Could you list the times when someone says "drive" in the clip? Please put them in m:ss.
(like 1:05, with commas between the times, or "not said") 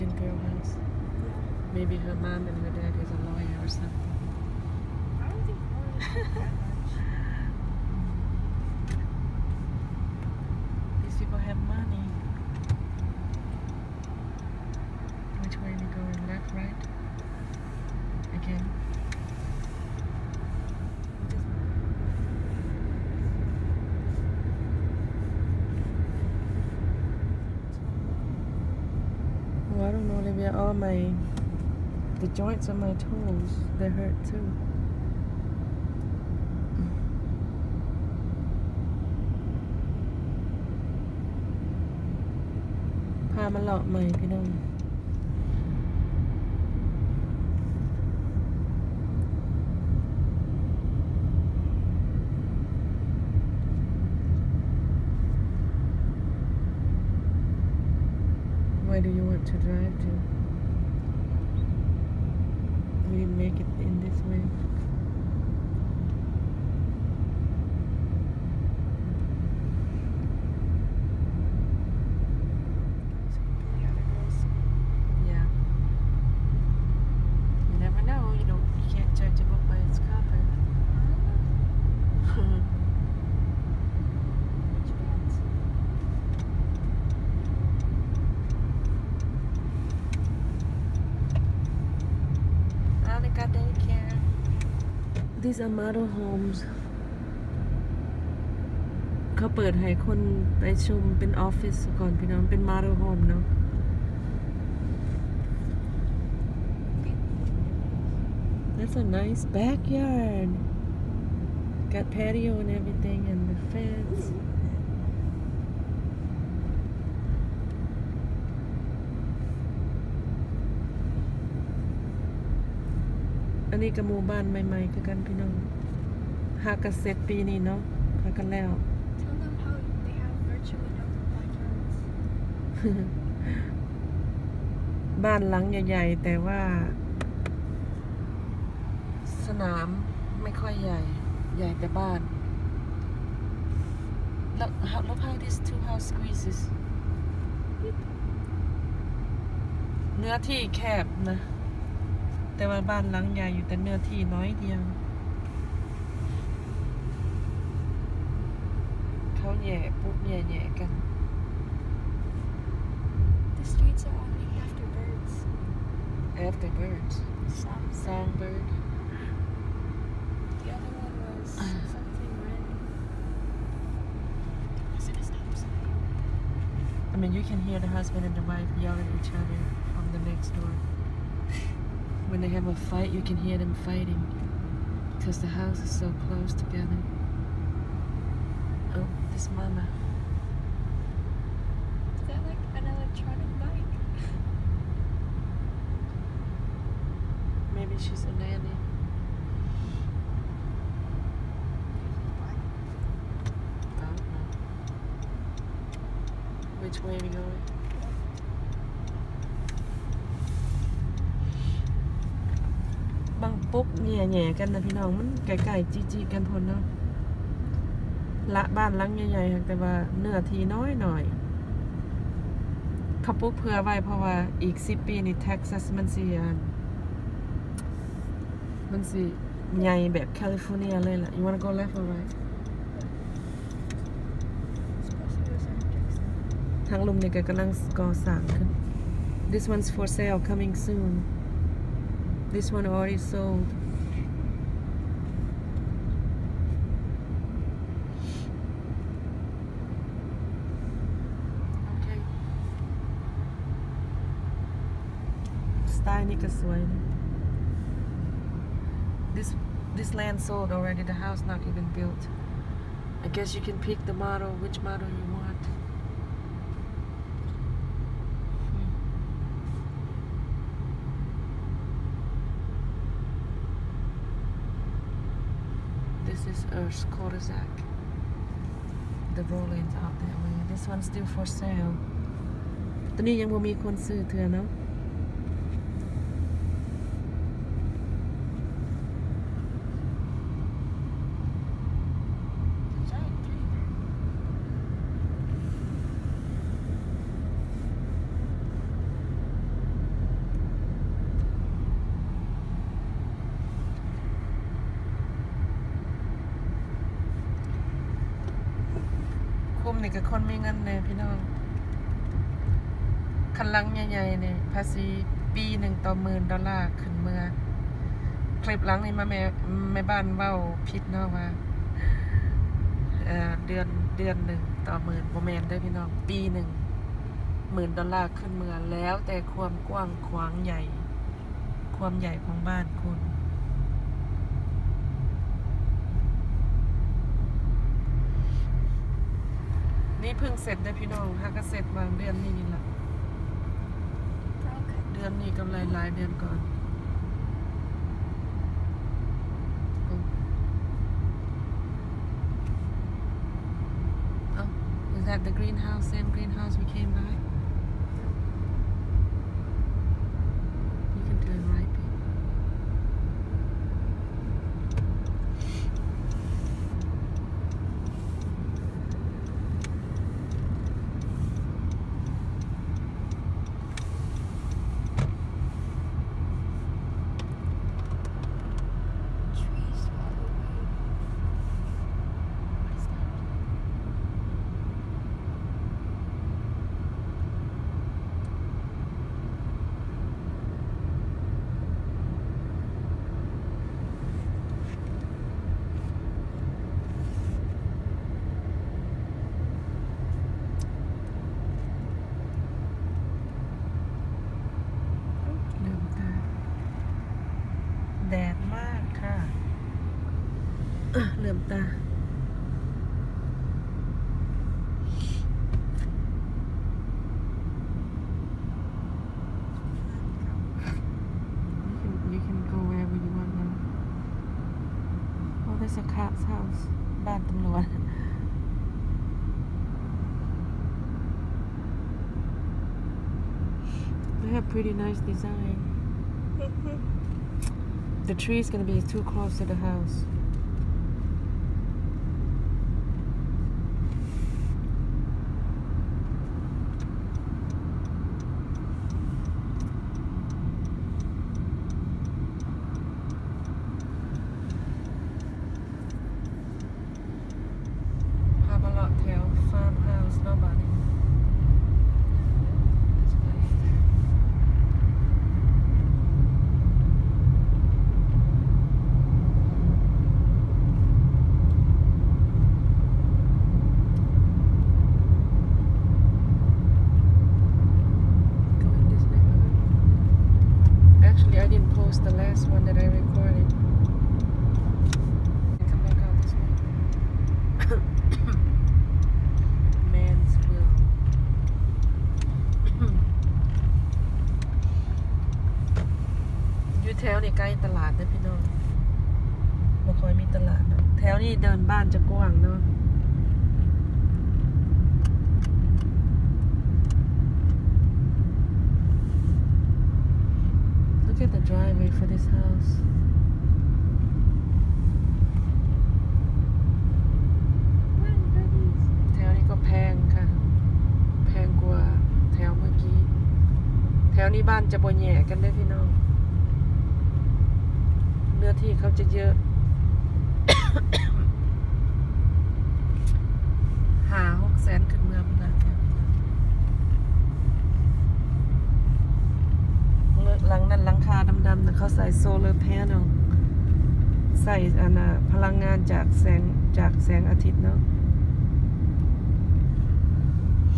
0:59.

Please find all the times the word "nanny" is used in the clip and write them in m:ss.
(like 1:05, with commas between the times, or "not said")
3:18.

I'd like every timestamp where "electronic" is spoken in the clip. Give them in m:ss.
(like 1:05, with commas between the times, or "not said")
3:12.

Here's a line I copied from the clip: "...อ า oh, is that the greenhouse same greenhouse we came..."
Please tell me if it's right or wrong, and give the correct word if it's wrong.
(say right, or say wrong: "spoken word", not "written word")
right.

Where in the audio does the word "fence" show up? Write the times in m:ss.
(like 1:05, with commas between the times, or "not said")
1:53.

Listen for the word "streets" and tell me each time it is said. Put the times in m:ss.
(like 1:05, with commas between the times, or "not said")
2:43.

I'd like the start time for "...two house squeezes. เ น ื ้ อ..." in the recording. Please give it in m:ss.
2:25.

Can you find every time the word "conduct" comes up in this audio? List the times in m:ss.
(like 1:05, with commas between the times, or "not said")
not said.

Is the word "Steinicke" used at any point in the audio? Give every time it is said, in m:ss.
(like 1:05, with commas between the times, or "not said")
4:15.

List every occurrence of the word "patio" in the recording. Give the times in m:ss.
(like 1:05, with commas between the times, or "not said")
1:52.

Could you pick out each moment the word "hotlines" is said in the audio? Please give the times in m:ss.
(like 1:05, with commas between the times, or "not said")
not said.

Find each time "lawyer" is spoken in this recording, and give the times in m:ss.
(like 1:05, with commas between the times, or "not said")
0:03.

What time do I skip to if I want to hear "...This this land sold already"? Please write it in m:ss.
4:19.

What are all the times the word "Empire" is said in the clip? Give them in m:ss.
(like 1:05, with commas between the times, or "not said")
not said.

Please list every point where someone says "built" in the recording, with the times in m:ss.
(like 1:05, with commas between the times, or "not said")
4:21.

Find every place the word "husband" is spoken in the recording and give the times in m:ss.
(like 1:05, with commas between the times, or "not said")
2:57.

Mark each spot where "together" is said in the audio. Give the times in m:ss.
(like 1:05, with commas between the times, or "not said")
3:06.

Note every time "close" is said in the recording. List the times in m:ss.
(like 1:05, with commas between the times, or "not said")
3:06, 7:19.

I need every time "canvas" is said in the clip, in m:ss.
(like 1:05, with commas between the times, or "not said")
not said.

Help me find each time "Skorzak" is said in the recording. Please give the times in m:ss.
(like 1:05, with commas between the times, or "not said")
4:36.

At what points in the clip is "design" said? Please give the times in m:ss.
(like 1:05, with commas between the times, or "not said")
7:15.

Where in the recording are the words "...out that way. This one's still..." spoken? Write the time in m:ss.
4:39.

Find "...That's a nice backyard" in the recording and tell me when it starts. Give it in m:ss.
1:48.